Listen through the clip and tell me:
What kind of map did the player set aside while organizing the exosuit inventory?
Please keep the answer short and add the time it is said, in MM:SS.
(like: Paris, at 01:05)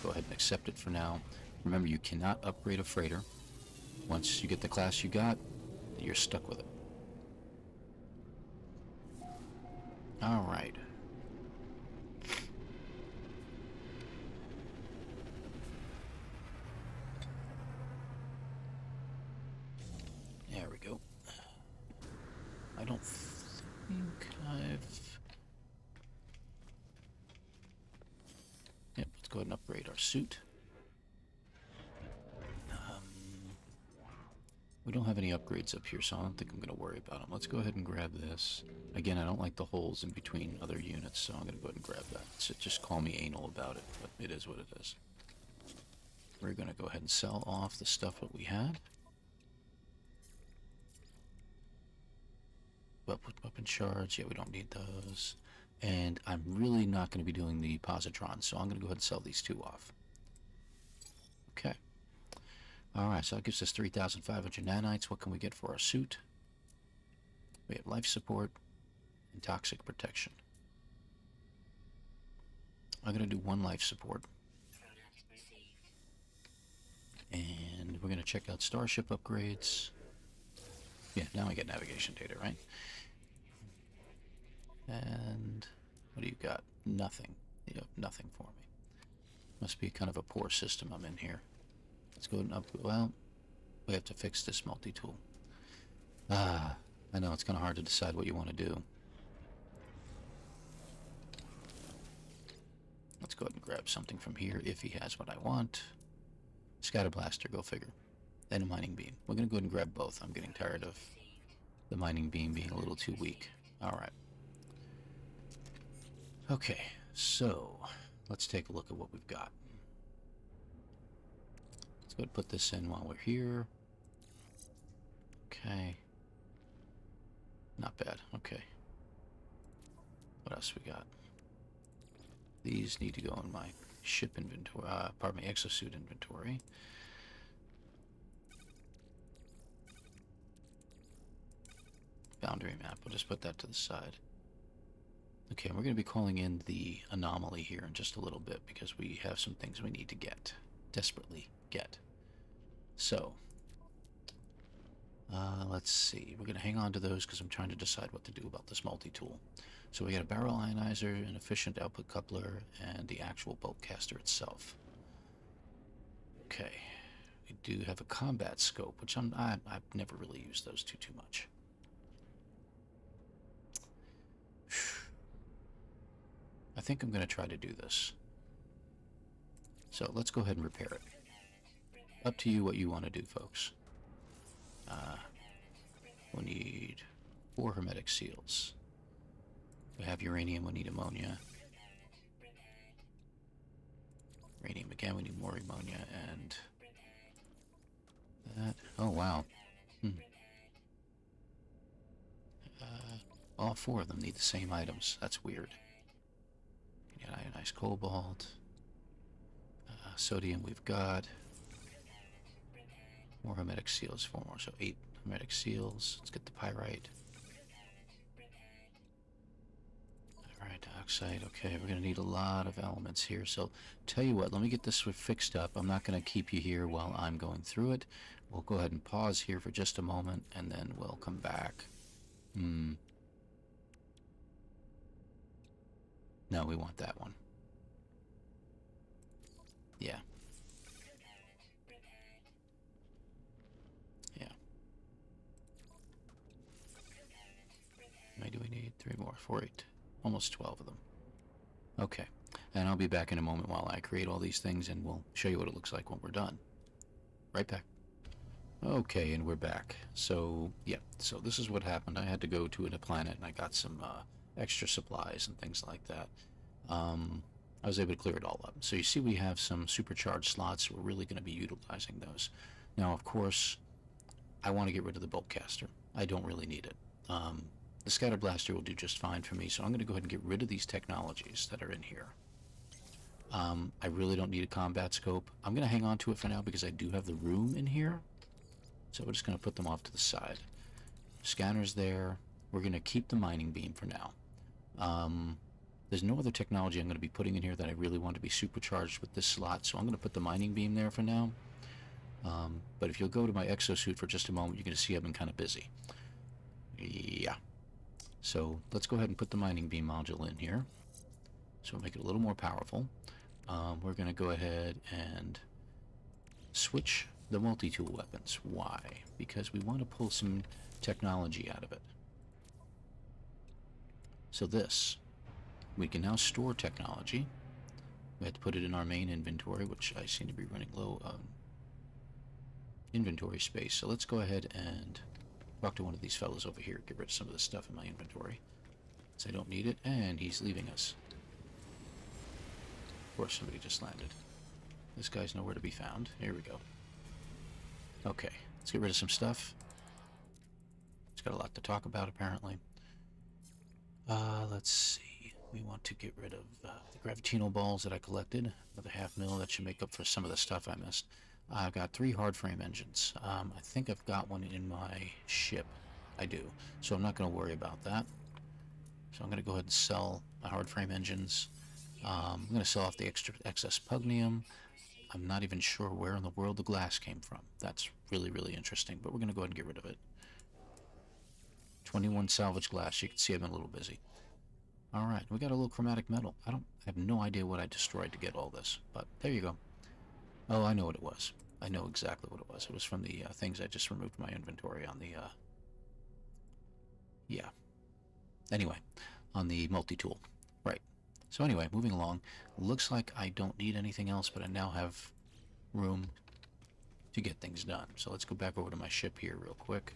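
Boundary map, at 02:22.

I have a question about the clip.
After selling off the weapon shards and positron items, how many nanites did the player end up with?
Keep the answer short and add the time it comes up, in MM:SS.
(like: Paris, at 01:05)
3,500, at 01:03.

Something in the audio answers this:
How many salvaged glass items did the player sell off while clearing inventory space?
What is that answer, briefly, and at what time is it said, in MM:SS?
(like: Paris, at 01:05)
21, at 06:22.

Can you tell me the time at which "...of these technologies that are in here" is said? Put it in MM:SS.
04:40.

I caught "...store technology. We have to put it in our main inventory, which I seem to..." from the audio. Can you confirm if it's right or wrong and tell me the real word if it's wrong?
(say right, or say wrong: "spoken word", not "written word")
right.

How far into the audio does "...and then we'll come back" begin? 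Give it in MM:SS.
03:50.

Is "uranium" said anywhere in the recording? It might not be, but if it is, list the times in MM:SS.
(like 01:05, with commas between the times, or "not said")
03:10, 03:14.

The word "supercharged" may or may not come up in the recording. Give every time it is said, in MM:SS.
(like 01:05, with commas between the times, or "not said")
04:29, 04:58.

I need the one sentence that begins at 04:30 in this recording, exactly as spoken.
We're really going to be utilizing those.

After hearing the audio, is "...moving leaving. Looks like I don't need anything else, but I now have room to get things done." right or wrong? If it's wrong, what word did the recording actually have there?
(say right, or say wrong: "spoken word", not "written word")
wrong: "along", not "leaving".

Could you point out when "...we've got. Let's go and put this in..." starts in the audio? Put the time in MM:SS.
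01:59.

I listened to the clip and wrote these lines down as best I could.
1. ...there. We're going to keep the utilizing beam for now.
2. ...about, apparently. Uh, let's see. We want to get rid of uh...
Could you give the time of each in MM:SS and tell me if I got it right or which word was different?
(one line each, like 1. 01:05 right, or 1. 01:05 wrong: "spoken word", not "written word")
1. 04:51 wrong: "mining", not "utilizing"
2. 05:52 right.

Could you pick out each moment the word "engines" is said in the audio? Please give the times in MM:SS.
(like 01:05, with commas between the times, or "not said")
06:02, 06:11.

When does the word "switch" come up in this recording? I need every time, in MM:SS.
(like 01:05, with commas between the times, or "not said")
05:16.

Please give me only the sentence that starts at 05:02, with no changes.
Um, but if you'll go to my exosuit for just a moment, you're going to see I've been kind of busy.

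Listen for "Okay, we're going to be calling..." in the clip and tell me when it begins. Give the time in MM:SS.
02:25.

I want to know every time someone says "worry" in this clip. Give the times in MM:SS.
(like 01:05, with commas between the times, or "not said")
00:36, 06:07.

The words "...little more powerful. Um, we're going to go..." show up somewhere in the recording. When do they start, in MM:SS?
05:12.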